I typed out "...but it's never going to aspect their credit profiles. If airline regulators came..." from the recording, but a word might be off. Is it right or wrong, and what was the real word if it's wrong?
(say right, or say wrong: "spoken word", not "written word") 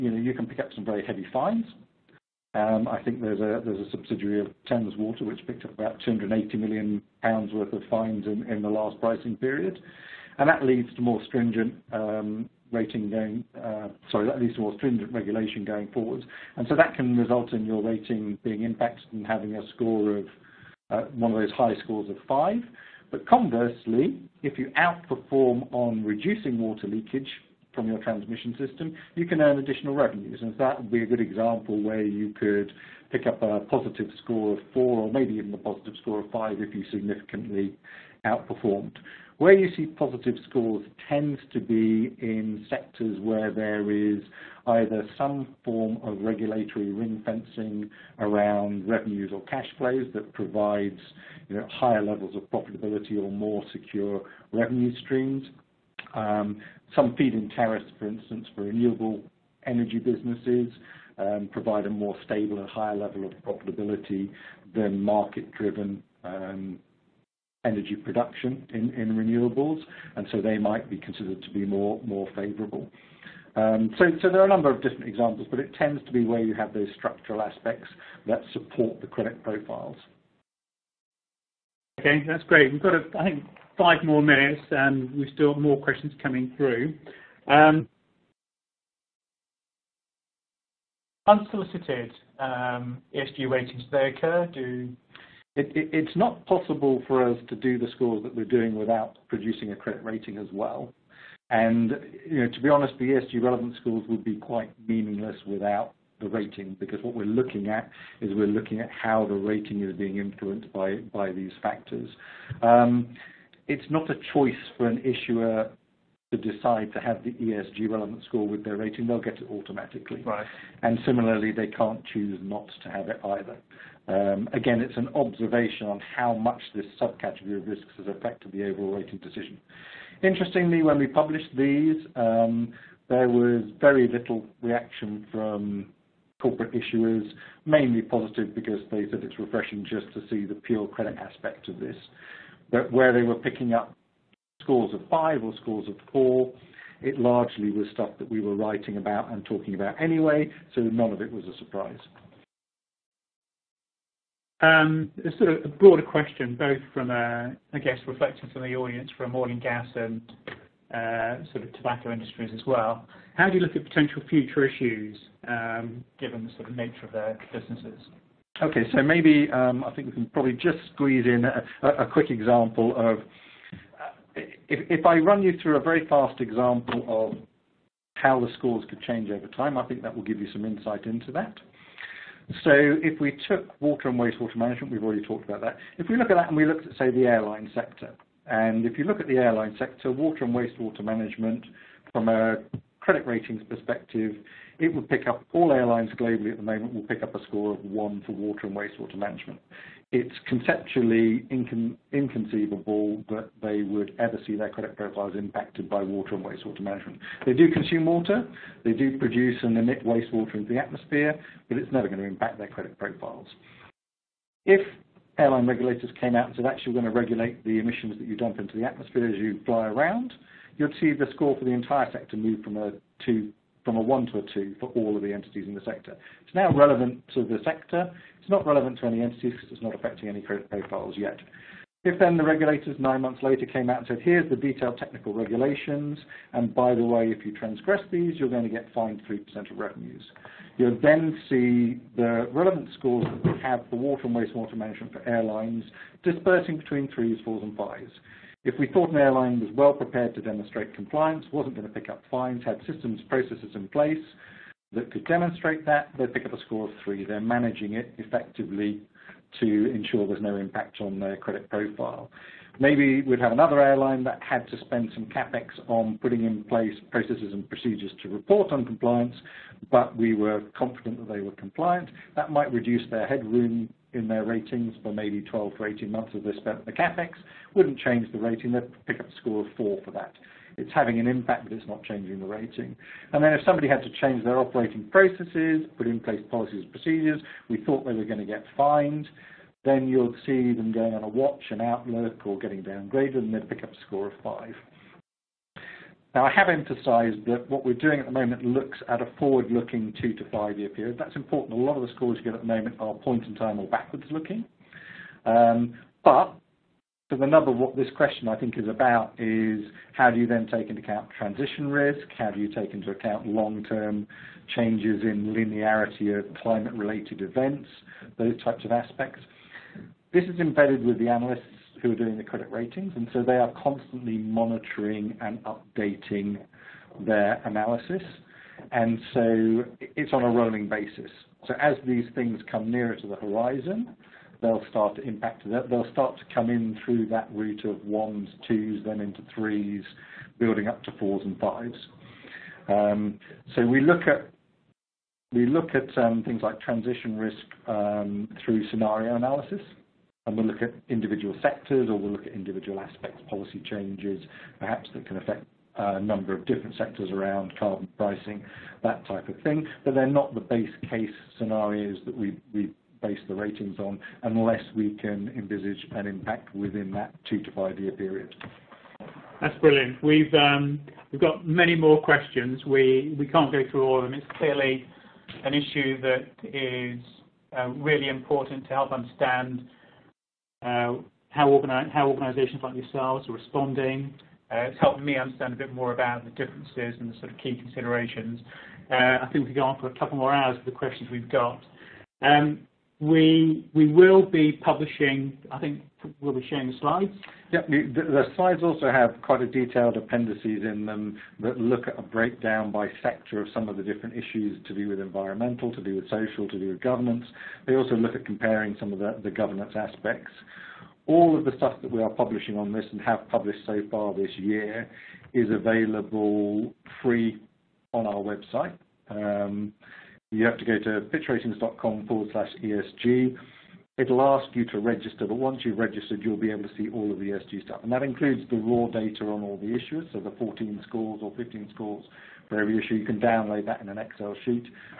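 wrong: "impact", not "aspect".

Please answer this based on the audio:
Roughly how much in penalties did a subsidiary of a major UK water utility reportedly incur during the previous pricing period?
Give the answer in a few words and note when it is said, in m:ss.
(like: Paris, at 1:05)
280 million pounds, at 0:06.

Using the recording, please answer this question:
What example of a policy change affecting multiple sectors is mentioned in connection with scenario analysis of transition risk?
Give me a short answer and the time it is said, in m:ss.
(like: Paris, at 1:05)
Carbon pricing, at 5:57.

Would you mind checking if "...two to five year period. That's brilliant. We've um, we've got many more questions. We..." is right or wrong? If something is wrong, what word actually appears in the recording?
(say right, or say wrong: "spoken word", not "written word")
right.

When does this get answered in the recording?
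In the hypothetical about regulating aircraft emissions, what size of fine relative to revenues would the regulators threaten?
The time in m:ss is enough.
3:59.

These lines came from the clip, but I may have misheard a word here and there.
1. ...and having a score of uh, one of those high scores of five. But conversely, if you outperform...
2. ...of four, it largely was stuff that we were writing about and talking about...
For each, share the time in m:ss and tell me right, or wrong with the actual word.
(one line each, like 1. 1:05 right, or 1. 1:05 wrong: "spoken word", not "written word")
1. 0:19 right
2. 2:25 right.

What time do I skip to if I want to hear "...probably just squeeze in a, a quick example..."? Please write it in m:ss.
2:50.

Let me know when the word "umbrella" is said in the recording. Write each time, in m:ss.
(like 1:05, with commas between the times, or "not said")
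not said.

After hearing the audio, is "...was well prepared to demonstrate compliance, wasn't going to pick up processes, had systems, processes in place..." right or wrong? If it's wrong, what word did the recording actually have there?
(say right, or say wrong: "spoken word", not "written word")
wrong: "fines", not "processes".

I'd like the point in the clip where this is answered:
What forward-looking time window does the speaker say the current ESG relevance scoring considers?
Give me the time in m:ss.
5:00.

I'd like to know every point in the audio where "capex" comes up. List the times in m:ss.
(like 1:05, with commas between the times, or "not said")
4:25, 4:36.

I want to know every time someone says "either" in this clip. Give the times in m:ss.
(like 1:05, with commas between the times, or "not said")
0:44, 2:03.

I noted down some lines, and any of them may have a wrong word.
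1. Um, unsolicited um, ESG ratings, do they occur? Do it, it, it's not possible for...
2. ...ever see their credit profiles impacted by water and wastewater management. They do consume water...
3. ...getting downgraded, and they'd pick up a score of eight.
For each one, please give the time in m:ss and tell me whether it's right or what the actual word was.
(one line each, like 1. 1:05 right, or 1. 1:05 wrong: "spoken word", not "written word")
1. 1:27 right
2. 3:24 right
3. 4:52 wrong: "five", not "eight".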